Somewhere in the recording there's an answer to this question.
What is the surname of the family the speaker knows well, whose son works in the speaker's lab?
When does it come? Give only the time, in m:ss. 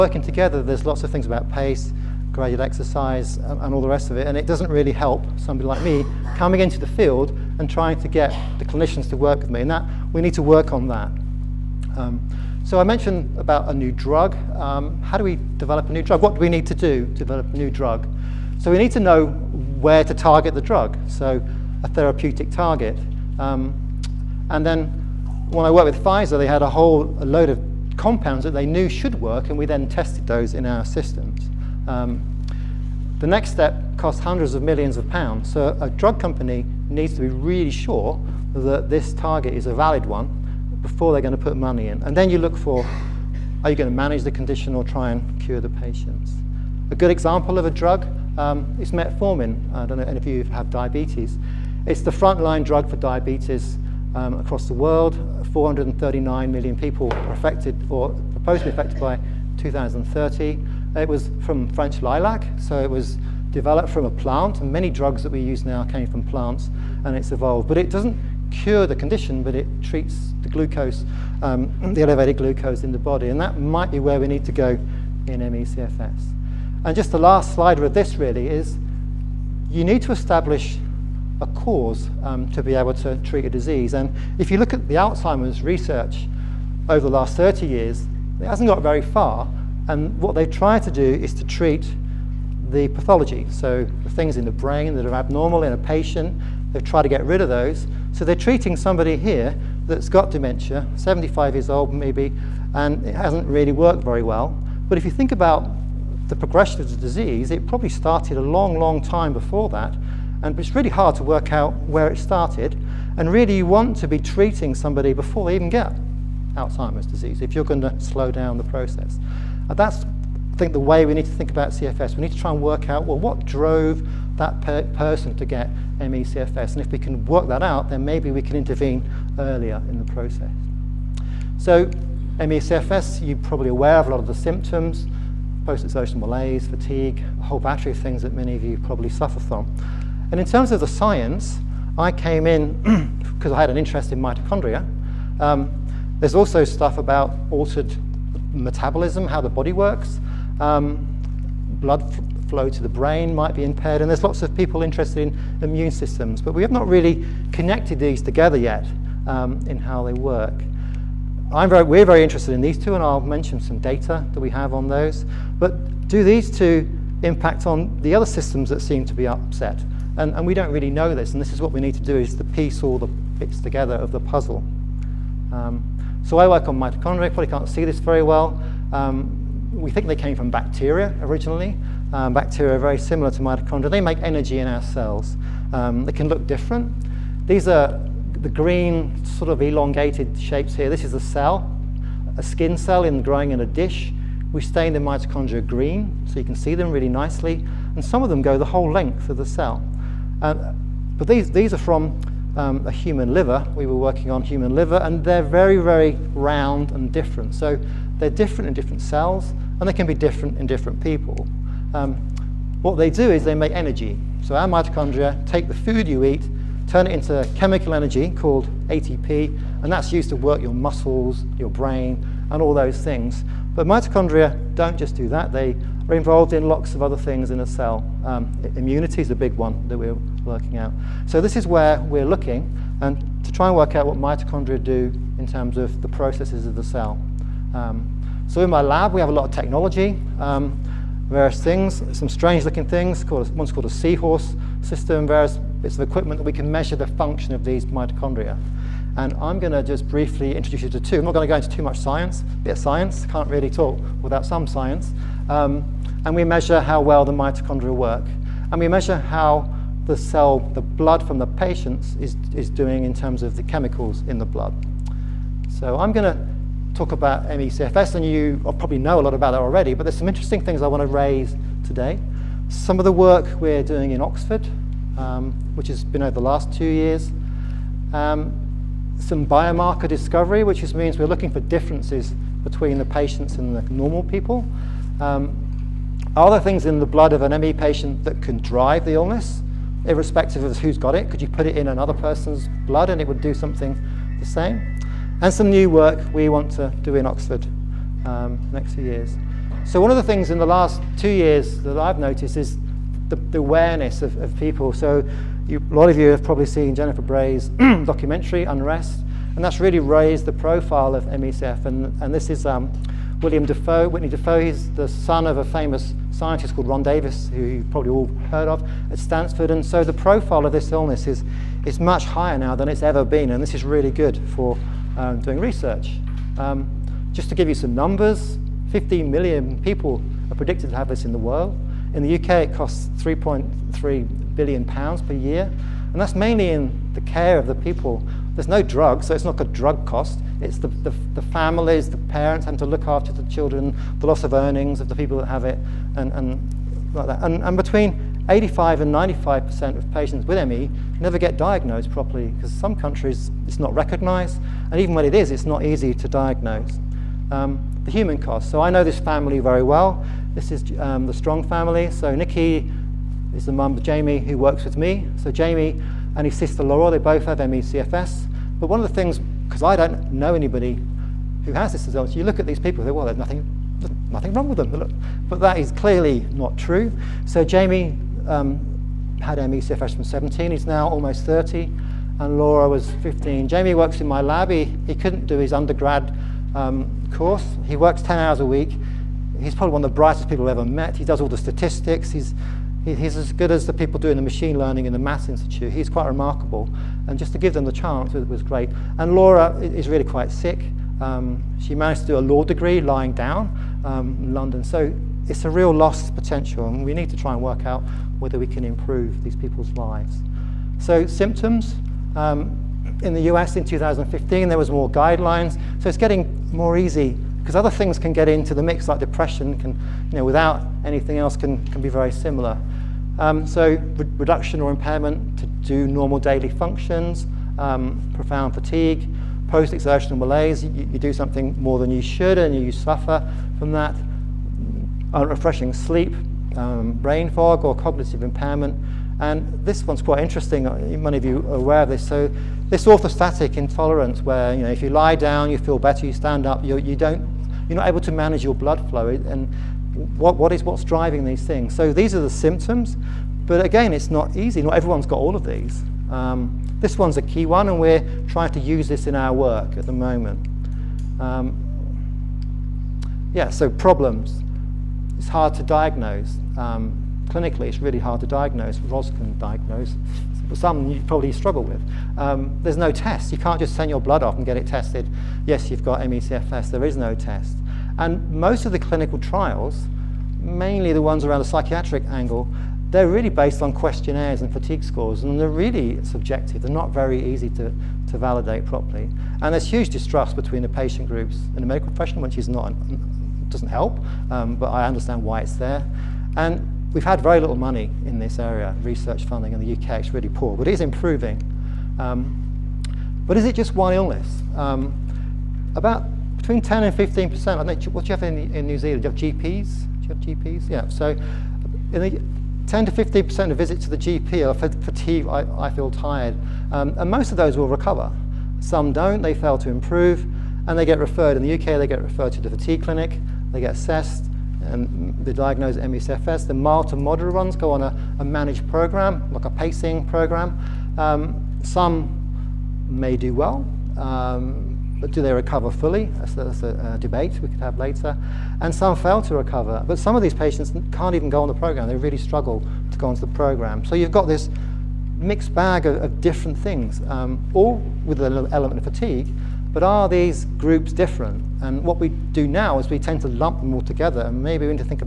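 6:01.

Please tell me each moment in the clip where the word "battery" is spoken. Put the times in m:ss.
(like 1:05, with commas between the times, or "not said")
2:17.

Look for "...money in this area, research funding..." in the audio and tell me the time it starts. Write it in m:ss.
8:17.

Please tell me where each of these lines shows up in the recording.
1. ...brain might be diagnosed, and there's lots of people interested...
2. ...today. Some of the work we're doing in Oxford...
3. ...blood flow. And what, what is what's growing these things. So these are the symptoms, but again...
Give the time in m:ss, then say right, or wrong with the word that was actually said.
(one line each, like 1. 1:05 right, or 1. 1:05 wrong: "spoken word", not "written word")
1. 2:32 wrong: "impaired", not "diagnosed"
2. 4:31 right
3. 7:28 wrong: "driving", not "growing".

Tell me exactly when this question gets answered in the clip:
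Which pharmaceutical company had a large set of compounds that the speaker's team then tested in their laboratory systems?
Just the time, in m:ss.
0:26.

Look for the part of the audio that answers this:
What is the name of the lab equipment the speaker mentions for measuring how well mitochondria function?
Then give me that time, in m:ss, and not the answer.
4:03.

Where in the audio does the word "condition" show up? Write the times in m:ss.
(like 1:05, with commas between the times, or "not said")
0:44, 1:08.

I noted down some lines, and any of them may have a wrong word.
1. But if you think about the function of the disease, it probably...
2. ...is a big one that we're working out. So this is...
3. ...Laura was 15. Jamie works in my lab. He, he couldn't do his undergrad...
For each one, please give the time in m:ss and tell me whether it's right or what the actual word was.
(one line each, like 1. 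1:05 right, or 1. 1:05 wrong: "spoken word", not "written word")
1. 1:44 wrong: "progression", not "function"
2. 3:49 right
3. 6:22 right.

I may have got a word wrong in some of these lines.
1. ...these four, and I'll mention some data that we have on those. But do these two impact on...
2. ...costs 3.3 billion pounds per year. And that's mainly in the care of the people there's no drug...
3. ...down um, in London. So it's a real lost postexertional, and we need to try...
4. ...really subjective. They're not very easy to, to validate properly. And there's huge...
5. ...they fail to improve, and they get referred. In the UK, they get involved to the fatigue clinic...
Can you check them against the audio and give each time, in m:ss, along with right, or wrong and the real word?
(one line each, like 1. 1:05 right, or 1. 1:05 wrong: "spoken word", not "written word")
1. 2:42 wrong: "two", not "four"
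2. 5:32 right
3. 6:43 wrong: "potential", not "postexertional"
4. 8:05 right
5. 8:39 wrong: "referred", not "involved".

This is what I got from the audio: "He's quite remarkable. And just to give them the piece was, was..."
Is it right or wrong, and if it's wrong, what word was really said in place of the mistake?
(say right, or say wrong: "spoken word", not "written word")
wrong: "chance", not "piece".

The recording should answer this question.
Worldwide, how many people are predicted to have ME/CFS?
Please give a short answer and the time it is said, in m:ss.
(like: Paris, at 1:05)
15 million, at 5:28.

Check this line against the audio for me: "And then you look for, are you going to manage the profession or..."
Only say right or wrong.
wrong.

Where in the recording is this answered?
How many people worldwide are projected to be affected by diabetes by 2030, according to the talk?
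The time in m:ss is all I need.
0:55.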